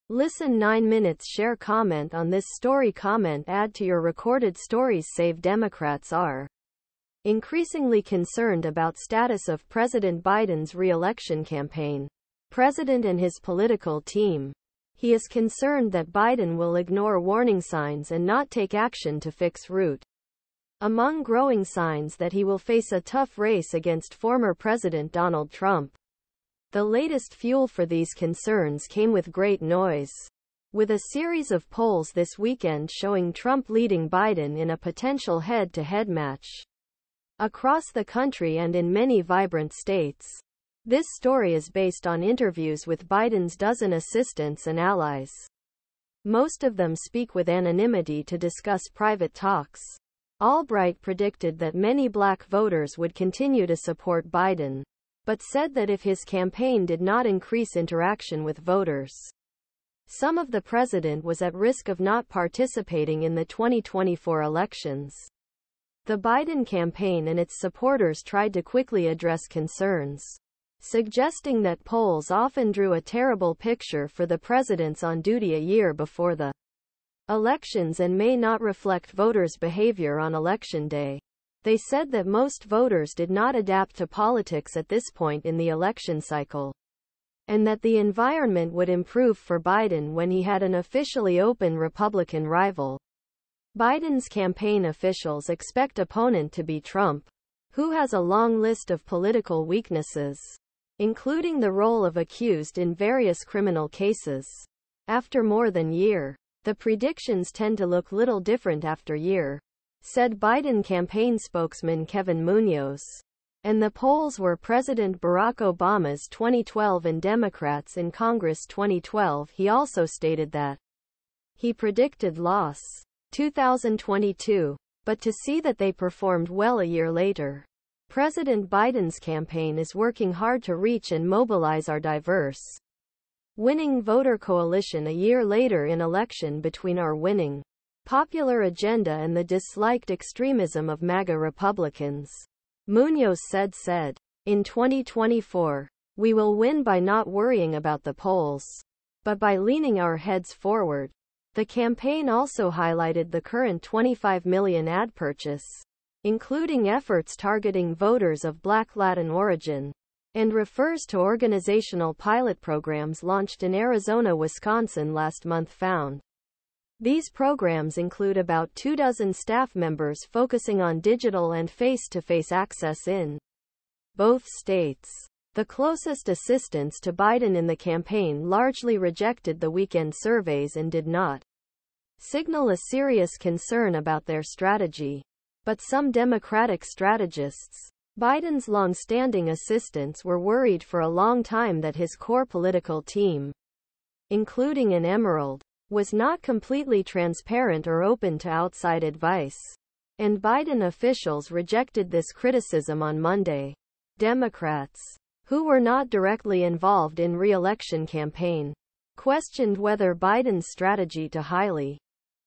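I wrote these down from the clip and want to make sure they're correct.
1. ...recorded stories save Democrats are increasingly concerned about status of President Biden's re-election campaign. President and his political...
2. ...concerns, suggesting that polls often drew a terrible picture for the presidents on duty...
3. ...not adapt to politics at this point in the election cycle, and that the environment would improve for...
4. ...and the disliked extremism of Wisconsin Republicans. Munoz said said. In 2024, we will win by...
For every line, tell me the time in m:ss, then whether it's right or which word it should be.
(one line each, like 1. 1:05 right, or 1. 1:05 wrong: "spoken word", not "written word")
1. 0:04 right
2. 1:09 right
3. 1:23 right
4. 2:19 wrong: "MAGA", not "Wisconsin".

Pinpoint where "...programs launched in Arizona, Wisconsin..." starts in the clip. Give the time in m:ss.
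2:42.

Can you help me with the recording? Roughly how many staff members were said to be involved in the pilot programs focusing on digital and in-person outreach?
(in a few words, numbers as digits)
about two dozen.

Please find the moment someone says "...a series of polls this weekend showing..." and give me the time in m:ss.
0:30.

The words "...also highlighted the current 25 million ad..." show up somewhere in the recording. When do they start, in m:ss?
2:32.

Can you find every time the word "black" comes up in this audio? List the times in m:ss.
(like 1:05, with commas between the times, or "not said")
0:52, 2:38.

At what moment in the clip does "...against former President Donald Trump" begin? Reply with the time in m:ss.
0:23.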